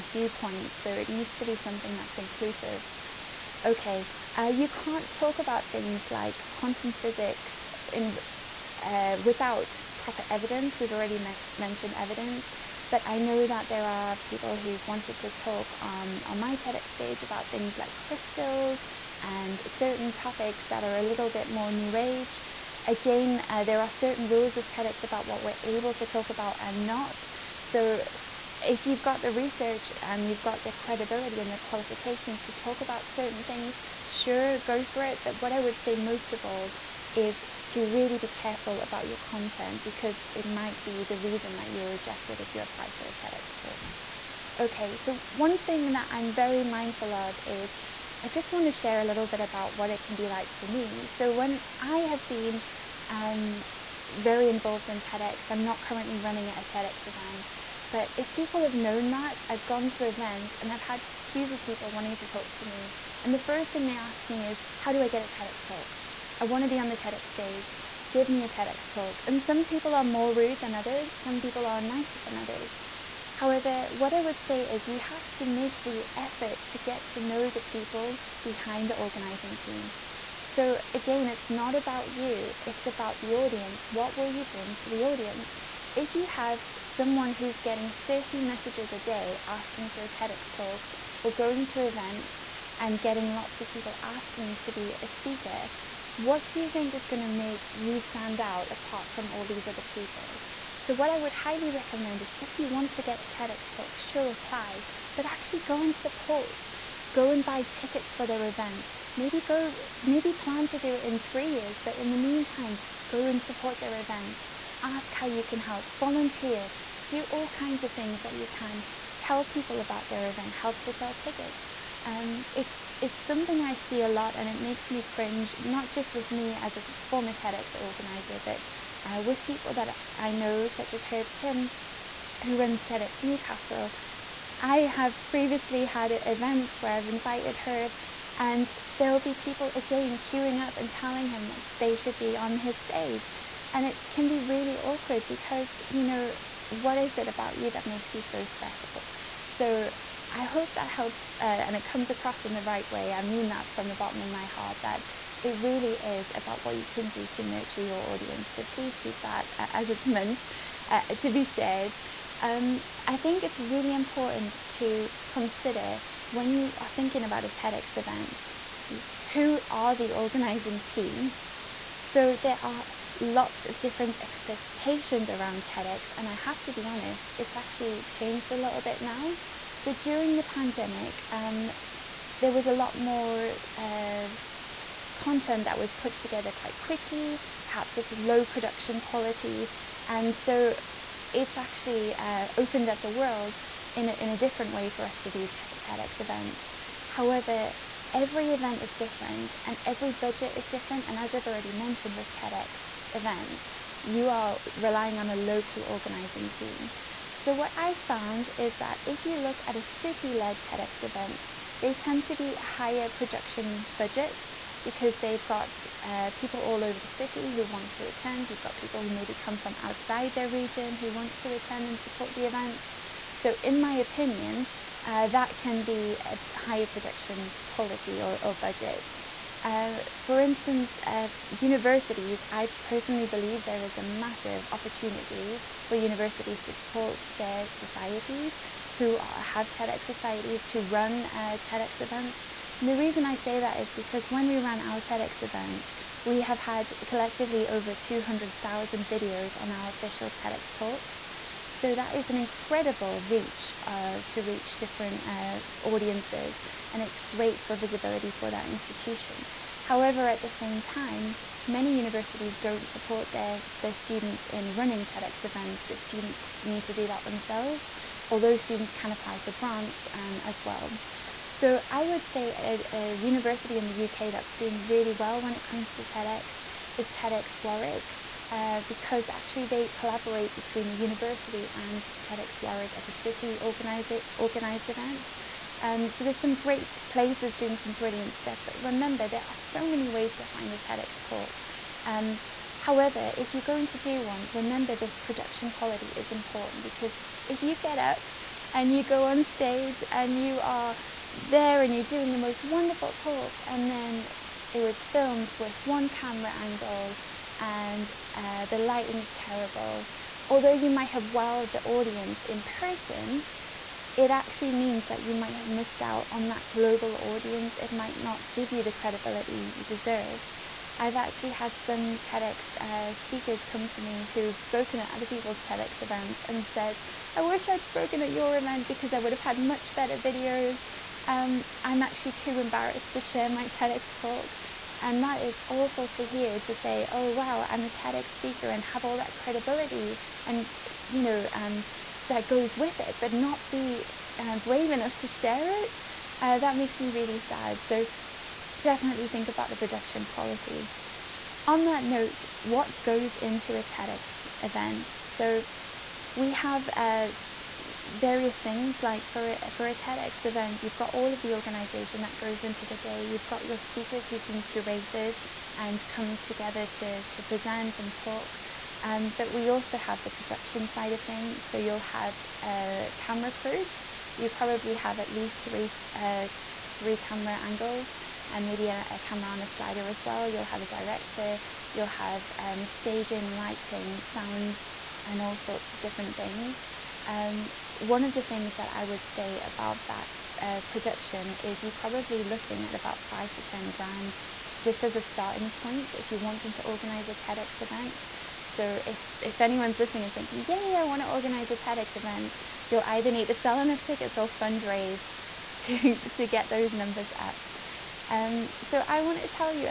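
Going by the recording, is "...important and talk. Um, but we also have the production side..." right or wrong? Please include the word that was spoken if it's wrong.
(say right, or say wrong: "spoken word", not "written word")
wrong: "present", not "important".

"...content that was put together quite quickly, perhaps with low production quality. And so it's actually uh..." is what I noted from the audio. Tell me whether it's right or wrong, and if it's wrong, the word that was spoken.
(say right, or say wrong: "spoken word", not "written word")
right.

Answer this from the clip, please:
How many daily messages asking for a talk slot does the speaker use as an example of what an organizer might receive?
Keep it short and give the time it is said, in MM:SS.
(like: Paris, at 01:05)
30, at 01:28.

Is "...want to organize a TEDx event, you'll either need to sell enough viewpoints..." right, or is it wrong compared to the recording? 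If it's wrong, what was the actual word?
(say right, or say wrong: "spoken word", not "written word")
wrong: "tickets", not "viewpoints".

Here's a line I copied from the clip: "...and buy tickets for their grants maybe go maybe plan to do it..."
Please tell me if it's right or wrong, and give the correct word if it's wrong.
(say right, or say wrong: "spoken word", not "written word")
wrong: "events", not "grants".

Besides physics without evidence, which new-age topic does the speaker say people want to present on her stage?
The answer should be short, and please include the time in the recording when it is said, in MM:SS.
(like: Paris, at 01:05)
crystals, at 00:17.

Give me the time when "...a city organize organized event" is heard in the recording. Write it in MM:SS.
04:43.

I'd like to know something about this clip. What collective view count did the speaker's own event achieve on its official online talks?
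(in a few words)
over 200,000.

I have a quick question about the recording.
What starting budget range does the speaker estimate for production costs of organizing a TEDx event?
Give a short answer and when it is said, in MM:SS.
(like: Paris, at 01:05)
5 to 10 grand, at 06:33.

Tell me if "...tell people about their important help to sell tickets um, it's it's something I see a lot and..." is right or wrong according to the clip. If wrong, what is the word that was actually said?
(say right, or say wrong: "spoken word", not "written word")
wrong: "event", not "important".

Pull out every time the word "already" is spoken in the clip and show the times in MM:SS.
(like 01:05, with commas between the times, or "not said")
00:10, 03:21.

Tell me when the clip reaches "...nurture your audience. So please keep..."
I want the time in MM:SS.
02:37.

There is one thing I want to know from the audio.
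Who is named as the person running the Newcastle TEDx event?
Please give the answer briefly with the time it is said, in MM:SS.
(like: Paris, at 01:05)
Herb Kim, at 02:11.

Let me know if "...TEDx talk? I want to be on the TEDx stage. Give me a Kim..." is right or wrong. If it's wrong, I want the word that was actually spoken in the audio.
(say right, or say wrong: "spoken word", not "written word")
wrong: "TEDx", not "Kim".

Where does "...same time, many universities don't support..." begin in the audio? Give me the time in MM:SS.
04:20.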